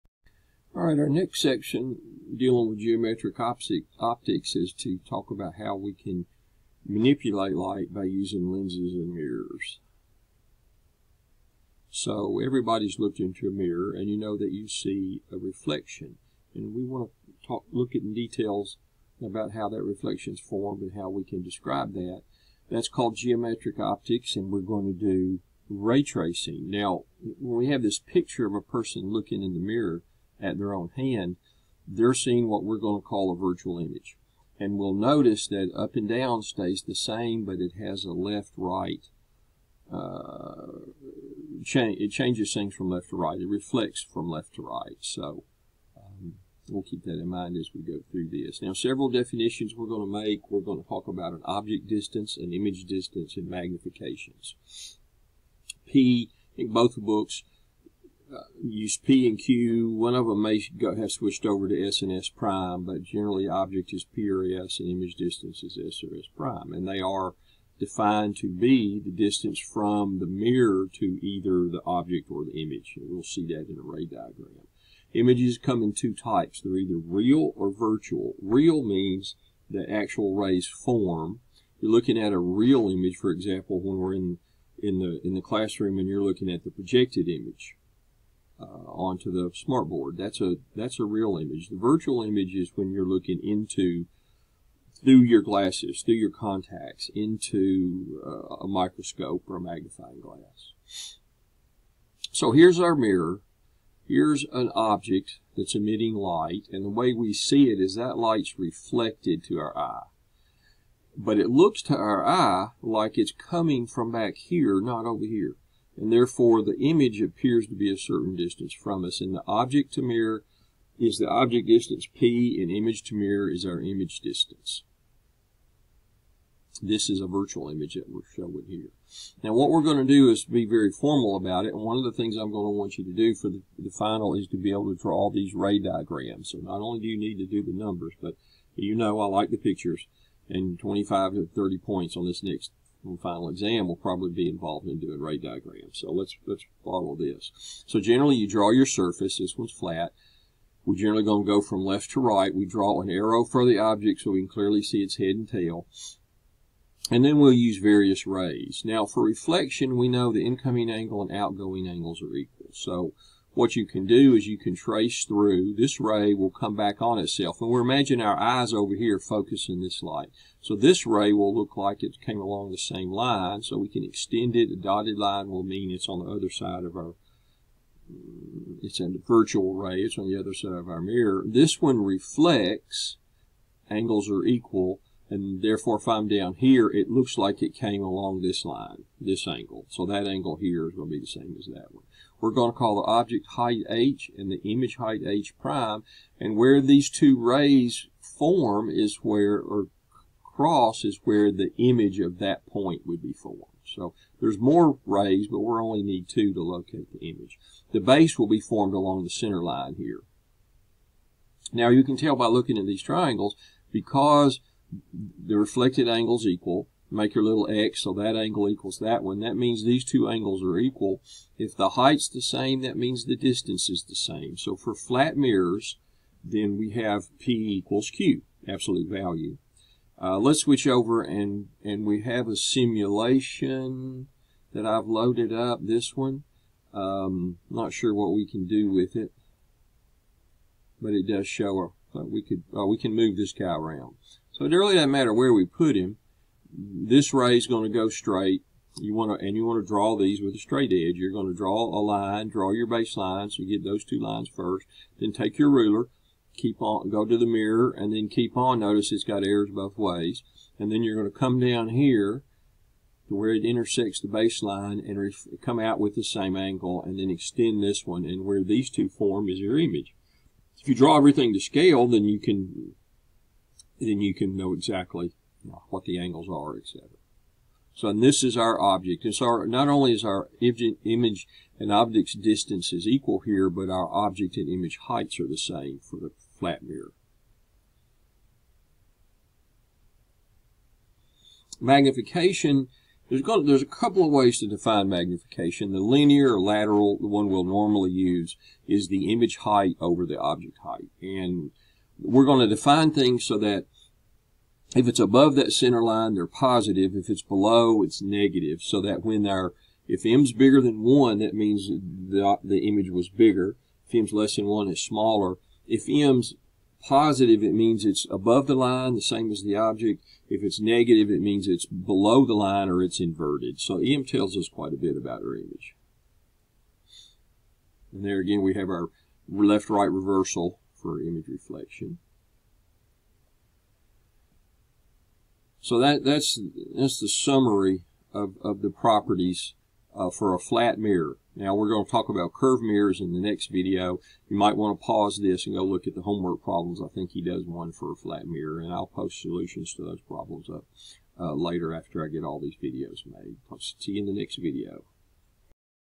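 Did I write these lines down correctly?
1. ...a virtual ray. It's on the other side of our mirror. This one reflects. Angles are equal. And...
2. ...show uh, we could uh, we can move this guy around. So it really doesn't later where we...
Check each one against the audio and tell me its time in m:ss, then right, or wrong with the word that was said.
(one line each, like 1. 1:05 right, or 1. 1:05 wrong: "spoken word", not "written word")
1. 2:59 right
2. 4:01 wrong: "matter", not "later".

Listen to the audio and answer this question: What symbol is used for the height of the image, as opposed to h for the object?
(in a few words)
h prime.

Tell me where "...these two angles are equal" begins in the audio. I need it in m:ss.
3:39.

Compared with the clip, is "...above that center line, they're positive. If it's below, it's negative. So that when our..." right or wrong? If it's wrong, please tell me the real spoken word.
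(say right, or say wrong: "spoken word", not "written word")
right.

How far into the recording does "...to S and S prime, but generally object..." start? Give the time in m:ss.
1:01.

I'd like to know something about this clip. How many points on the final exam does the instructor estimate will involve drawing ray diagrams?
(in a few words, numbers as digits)
25 to 30.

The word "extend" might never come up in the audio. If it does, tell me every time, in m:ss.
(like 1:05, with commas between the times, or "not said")
2:54, 4:27.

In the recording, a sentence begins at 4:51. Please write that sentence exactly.
Magnification, there's, going, there's a couple of ways to define magnification.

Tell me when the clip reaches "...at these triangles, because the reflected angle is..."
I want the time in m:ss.
3:32.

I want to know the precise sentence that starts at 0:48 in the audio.
Now, several definitions we're going to make.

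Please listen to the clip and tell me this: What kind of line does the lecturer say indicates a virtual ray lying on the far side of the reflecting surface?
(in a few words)
dotted line.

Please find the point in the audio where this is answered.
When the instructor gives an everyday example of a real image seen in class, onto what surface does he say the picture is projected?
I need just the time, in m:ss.
1:29.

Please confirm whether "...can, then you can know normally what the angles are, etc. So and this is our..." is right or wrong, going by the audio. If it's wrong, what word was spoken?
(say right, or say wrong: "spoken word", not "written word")
wrong: "exactly", not "normally".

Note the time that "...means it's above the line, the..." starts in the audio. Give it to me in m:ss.
5:17.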